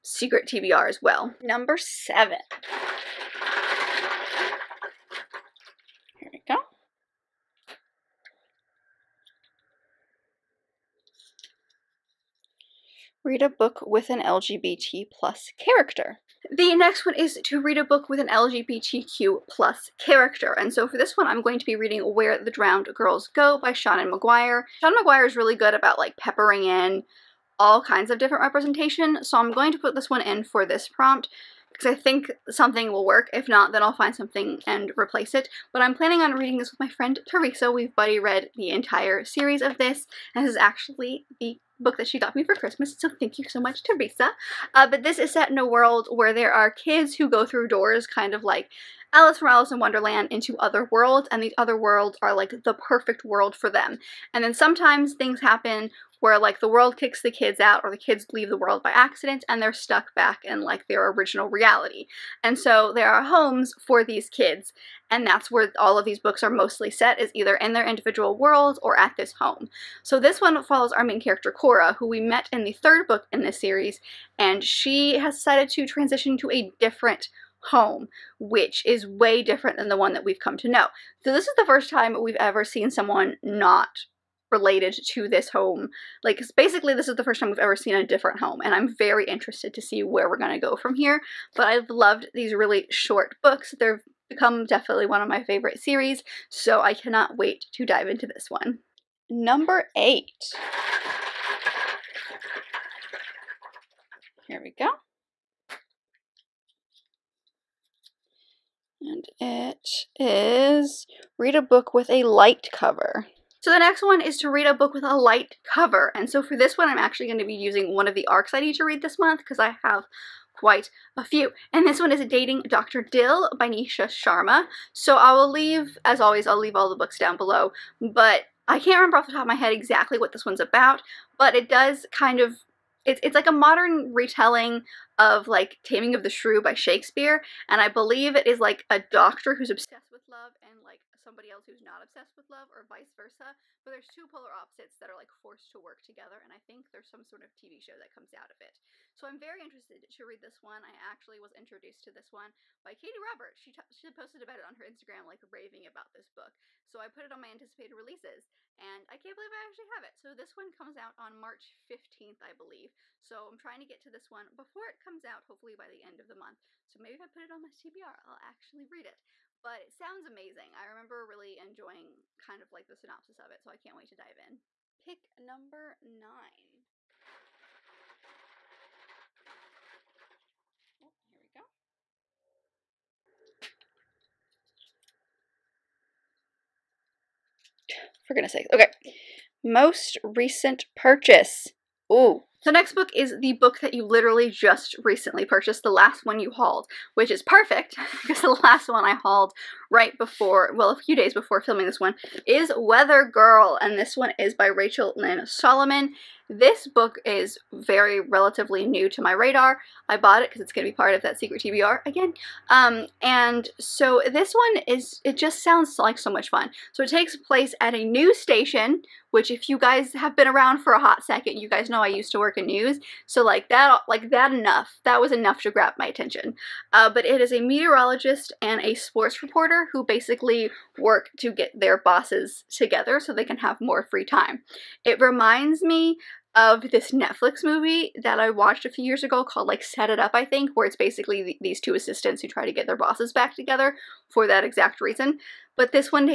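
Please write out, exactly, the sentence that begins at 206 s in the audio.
This book is very relatively new to my radar.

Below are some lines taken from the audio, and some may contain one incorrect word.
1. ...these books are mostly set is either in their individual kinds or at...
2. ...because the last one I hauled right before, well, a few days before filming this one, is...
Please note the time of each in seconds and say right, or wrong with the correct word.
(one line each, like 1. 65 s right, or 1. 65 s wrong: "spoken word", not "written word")
1. 66 s wrong: "worlds", not "kinds"
2. 198 s right.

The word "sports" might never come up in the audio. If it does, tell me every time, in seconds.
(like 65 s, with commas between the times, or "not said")
228 s.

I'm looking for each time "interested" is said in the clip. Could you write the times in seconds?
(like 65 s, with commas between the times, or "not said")
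89 s, 149 s.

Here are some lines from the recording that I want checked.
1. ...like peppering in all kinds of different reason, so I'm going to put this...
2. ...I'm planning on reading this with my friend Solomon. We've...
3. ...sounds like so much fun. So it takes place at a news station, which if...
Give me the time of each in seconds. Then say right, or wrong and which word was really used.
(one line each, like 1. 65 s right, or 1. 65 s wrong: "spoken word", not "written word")
1. 25 s wrong: "representation", not "reason"
2. 35 s wrong: "Teresa", not "Solomon"
3. 215 s right.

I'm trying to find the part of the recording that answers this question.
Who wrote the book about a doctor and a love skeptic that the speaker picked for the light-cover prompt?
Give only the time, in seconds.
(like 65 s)
123 s.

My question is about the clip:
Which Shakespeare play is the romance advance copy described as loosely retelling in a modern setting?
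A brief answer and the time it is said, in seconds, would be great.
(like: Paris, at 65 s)
Taming of the Shrew, at 135 s.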